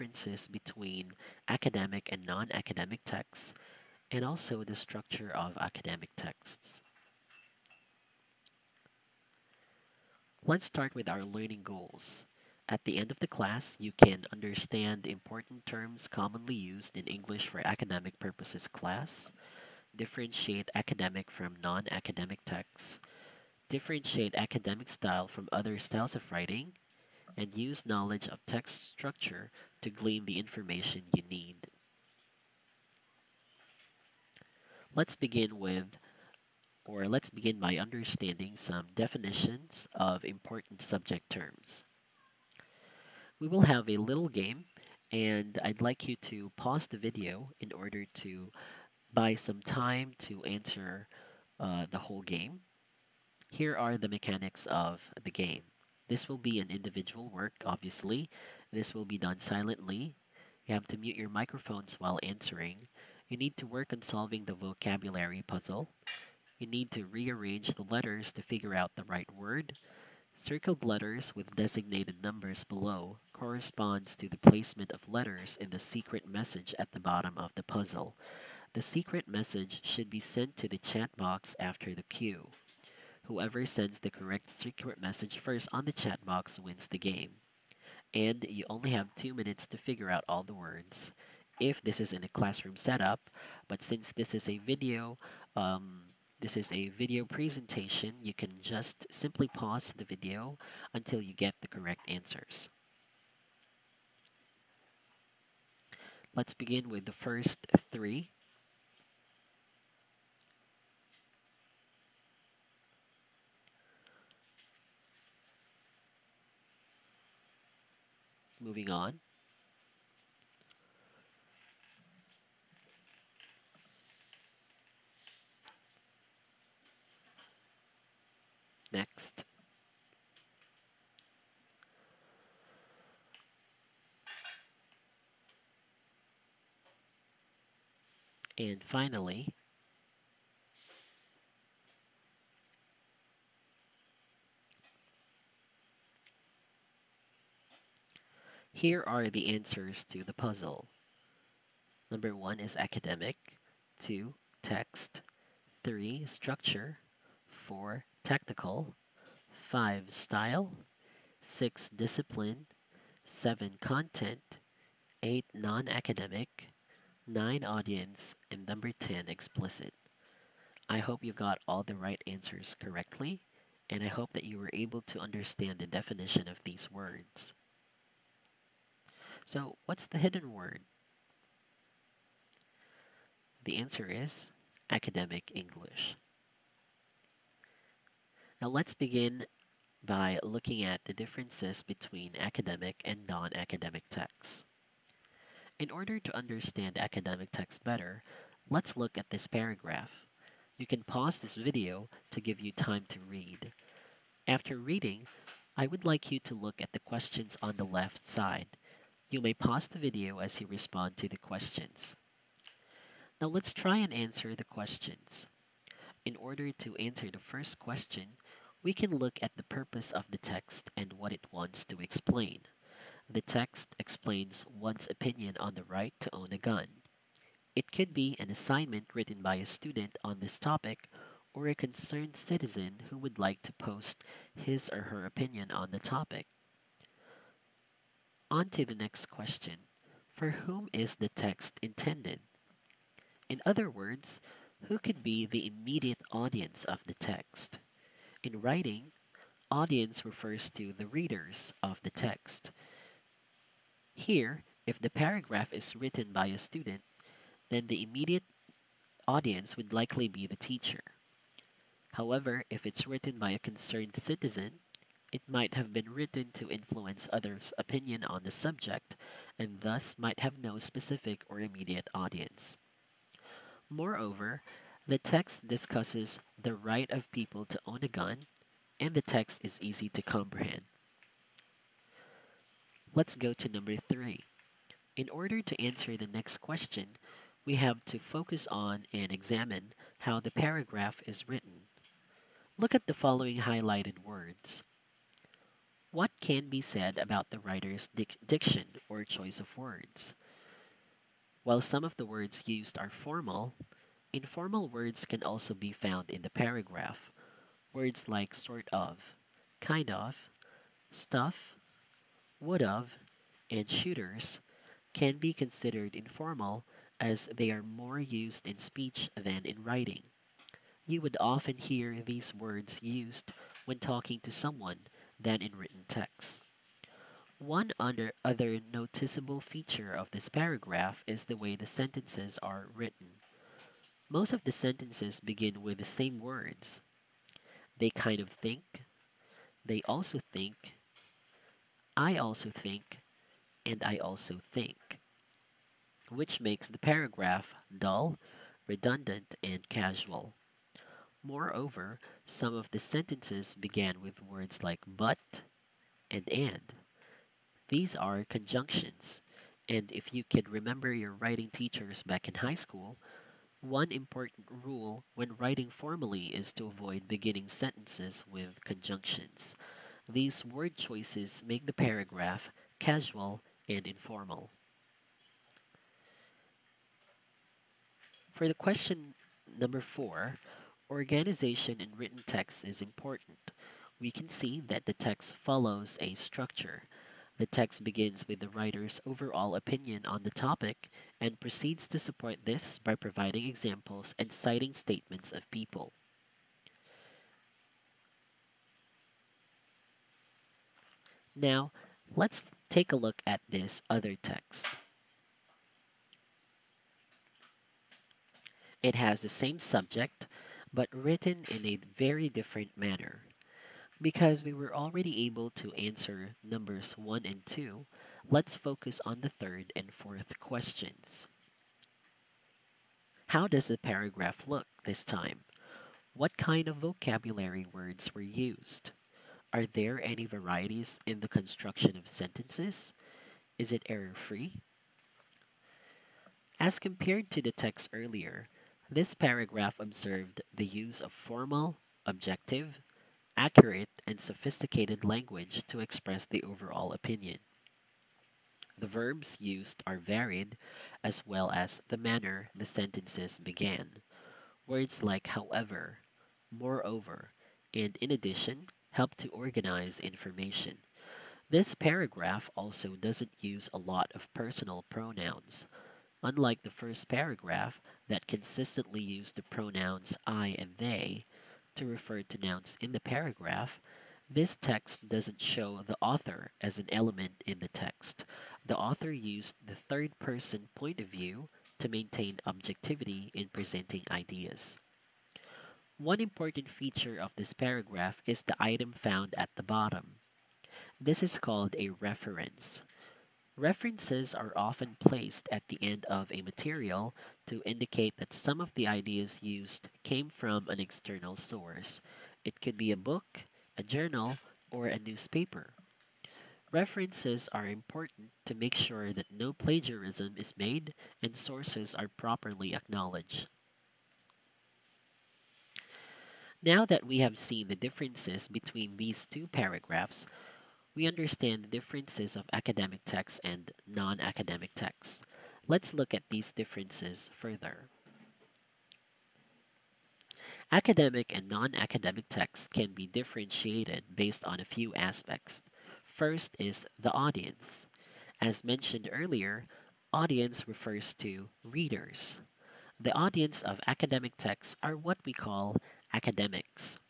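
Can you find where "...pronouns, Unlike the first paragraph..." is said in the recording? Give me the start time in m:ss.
7:45.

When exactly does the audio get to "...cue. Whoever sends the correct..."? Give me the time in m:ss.
1:22.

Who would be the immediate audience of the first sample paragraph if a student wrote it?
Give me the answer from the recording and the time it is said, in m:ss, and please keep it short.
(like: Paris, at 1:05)
The teacher, at 4:20.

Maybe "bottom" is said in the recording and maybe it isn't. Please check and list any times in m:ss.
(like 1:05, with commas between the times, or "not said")
1:16, 8:09.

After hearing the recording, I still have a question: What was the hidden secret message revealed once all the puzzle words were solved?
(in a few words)
Academic English.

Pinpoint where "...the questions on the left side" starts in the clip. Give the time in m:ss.
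3:26.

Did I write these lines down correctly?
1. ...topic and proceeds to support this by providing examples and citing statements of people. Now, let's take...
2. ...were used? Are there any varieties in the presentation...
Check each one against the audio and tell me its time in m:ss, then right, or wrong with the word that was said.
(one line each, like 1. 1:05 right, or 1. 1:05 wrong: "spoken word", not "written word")
1. 6:30 right
2. 7:08 wrong: "construction", not "presentation".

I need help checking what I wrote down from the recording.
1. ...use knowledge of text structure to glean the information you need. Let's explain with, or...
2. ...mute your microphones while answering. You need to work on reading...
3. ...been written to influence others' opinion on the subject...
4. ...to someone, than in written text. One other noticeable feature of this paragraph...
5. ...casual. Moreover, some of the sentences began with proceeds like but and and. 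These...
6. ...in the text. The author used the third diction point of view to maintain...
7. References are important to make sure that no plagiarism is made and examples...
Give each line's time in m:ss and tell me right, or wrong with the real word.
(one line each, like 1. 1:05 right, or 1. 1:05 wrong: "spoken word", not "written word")
1. 0:27 wrong: "begin", not "explain"
2. 1:00 wrong: "solving", not "reading"
3. 4:25 right
4. 5:24 right
5. 5:49 wrong: "words", not "proceeds"
6. 7:57 wrong: "person", not "diction"
7. 8:26 wrong: "sources", not "examples".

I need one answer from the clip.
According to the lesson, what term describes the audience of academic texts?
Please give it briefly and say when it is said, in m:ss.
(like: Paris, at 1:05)
Academics, at 9:06.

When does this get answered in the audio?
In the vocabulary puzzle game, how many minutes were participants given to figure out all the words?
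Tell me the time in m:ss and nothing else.
1:29.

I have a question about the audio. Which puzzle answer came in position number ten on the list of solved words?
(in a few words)
Explicit.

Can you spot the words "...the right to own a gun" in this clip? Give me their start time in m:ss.
3:45.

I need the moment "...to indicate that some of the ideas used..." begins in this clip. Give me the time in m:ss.
8:17.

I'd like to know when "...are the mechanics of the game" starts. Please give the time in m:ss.
0:53.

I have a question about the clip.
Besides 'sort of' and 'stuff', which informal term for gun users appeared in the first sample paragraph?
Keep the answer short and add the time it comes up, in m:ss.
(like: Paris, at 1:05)
Shooters, at 5:13.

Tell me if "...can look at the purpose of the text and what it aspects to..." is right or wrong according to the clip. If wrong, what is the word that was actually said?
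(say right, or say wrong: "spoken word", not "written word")
wrong: "wants", not "aspects".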